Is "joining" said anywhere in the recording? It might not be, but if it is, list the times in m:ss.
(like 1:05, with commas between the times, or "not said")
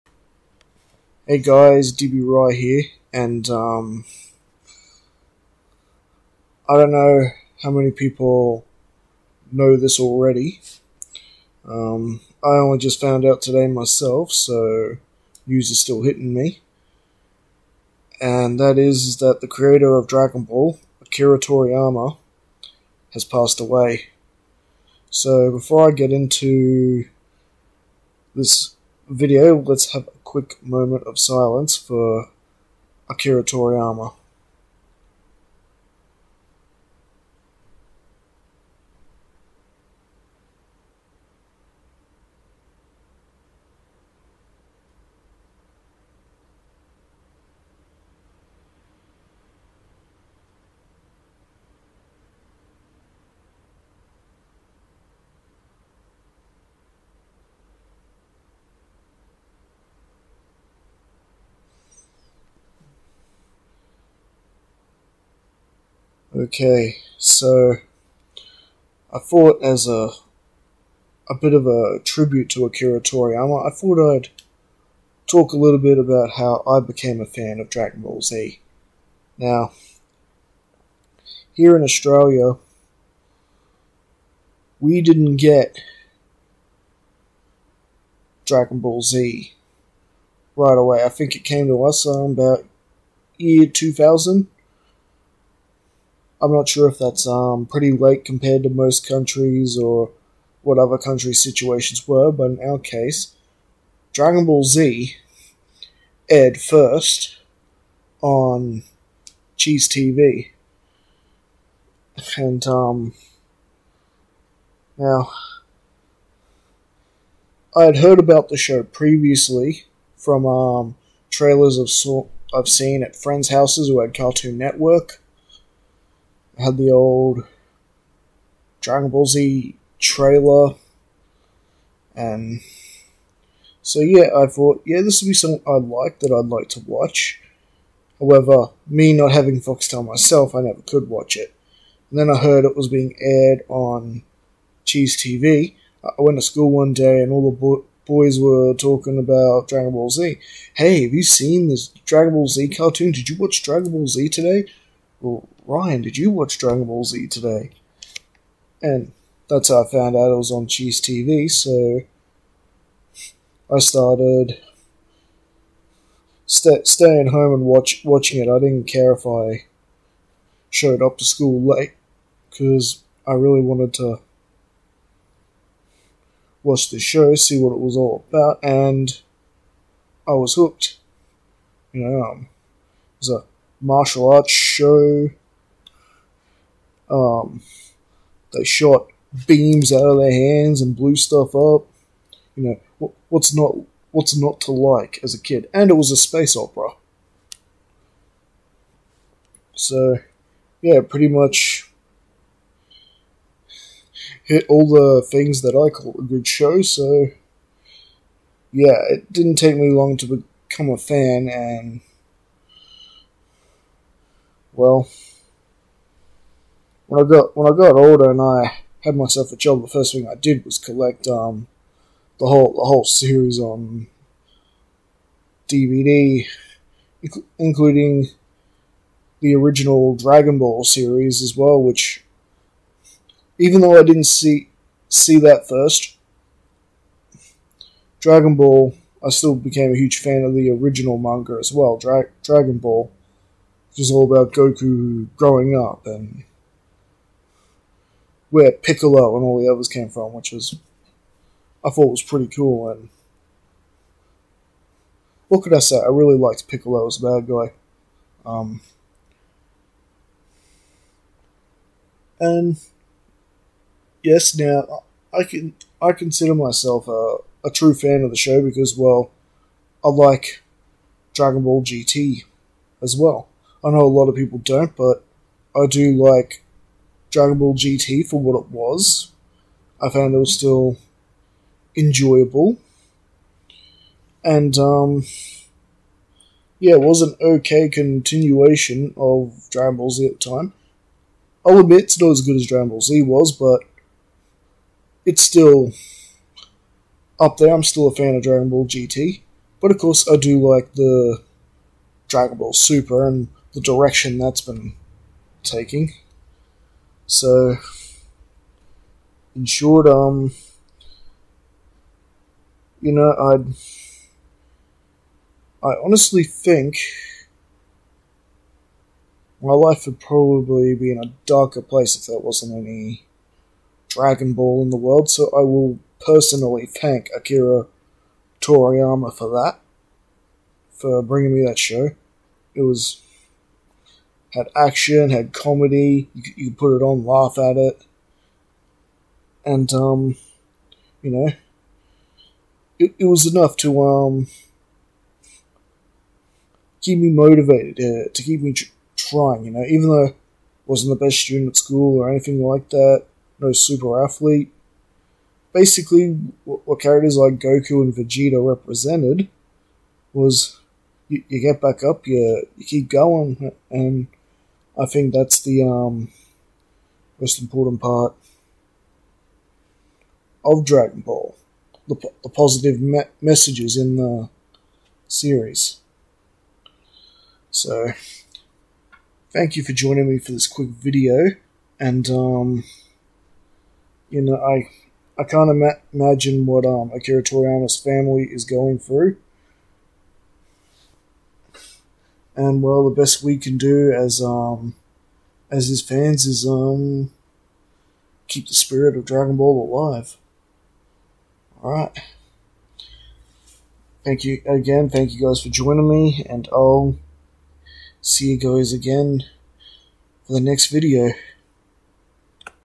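6:19, 6:45.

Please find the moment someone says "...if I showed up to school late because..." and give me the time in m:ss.
2:49.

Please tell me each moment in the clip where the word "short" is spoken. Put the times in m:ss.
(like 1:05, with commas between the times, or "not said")
5:09.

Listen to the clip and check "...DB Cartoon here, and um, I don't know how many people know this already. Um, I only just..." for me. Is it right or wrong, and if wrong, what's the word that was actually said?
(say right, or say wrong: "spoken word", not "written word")
wrong: "Roy", not "Cartoon".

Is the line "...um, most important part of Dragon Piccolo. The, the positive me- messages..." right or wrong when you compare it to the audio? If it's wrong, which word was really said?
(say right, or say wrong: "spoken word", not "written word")
wrong: "Ball", not "Piccolo".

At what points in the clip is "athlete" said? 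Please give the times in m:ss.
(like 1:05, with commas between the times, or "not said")
5:54.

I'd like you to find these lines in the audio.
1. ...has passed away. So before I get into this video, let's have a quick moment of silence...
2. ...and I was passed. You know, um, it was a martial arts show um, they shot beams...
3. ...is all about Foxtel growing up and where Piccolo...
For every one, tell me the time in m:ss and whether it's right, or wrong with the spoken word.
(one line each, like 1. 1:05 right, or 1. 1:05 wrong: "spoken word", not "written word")
1. 0:23 right
2. 2:58 wrong: "hooked", not "passed"
3. 4:03 wrong: "Goku", not "Foxtel".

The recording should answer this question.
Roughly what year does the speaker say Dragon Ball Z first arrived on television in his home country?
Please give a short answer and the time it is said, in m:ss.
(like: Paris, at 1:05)
2000, at 1:33.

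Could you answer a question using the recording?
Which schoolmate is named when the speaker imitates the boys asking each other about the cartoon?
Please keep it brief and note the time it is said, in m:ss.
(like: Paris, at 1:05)
Ryan, at 2:35.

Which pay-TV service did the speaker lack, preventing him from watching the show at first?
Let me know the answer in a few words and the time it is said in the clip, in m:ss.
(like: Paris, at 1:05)
Foxtel, at 2:19.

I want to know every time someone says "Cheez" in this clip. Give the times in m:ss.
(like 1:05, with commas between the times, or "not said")
1:49, 2:24, 2:40.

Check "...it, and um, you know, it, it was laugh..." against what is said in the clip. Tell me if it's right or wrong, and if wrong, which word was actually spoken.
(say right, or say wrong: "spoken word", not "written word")
wrong: "enough", not "laugh".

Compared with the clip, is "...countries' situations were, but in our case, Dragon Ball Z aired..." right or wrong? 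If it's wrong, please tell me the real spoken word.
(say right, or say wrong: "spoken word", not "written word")
right.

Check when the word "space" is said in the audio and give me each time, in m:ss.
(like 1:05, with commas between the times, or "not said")
3:16.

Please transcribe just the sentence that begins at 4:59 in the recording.
But of course, I do like the Dragon Ball Super and the direction that's been taking.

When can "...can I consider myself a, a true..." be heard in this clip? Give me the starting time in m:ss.
4:25.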